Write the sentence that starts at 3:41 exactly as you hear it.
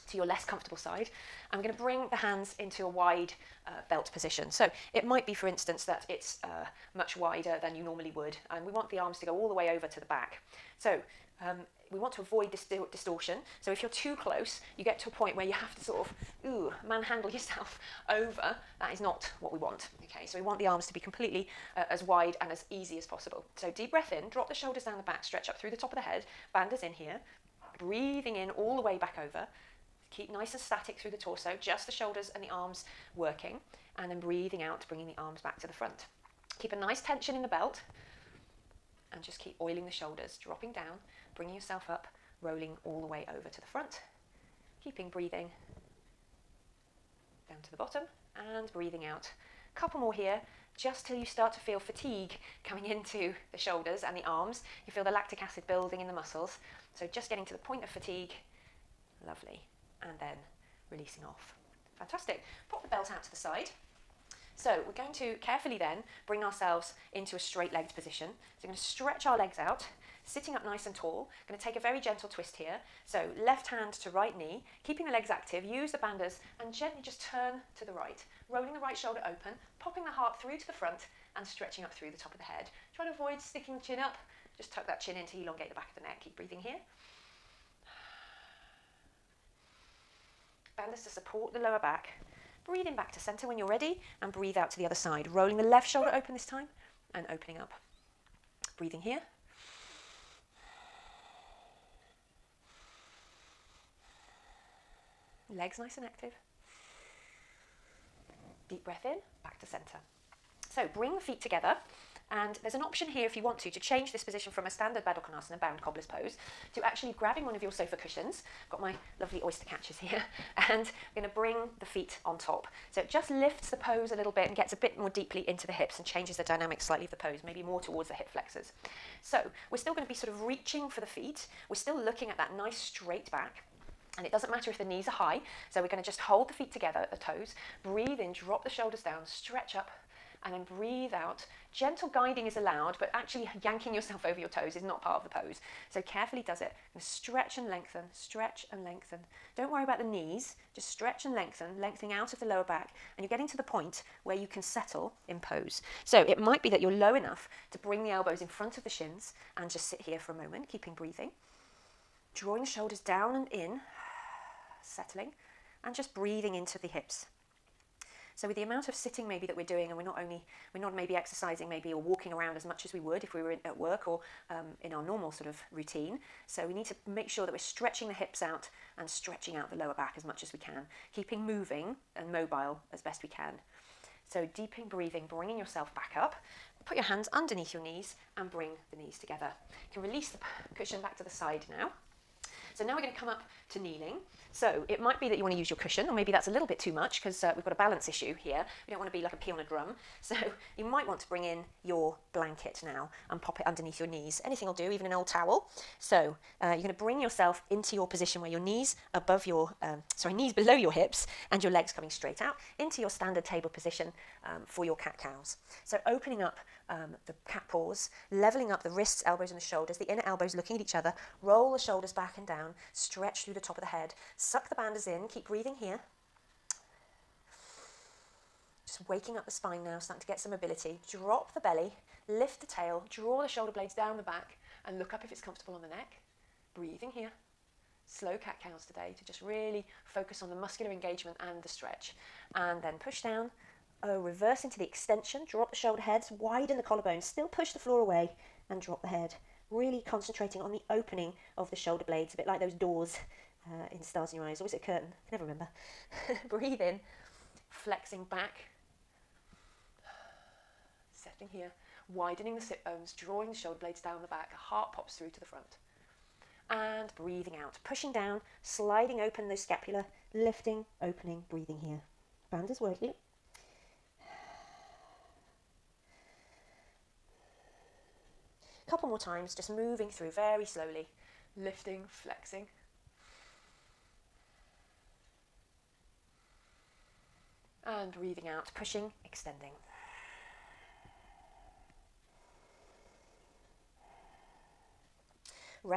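Roll the shoulders back and down, stretch through the top of the head, suck the bandhas in, keep breathing here.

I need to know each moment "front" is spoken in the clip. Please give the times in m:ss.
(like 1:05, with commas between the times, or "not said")
0:35, 0:43, 1:20, 2:38, 4:25.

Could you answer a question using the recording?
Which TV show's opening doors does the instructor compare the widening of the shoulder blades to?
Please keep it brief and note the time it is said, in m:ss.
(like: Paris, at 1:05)
Stars in Your Eyes, at 4:14.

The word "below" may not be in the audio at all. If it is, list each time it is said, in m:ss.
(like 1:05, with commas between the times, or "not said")
3:30.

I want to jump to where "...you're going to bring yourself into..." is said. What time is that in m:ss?
3:26.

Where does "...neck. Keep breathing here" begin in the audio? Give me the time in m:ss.
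1:26.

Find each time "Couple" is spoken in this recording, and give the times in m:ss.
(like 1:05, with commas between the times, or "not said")
0:49, 4:38.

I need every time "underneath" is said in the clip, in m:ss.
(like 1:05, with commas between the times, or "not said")
3:07, 3:23.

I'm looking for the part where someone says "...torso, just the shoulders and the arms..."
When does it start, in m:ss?
0:31.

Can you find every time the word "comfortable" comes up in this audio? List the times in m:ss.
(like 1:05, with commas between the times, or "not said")
0:00, 3:55.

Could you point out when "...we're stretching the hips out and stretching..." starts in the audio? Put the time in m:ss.
2:57.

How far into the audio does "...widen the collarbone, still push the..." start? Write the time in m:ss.
4:06.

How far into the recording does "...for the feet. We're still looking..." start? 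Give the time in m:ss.
2:10.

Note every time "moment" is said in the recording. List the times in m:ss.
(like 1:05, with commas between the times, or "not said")
2:40.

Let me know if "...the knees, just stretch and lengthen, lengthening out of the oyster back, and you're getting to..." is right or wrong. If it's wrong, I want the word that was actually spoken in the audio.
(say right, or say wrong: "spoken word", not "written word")
wrong: "lower", not "oyster".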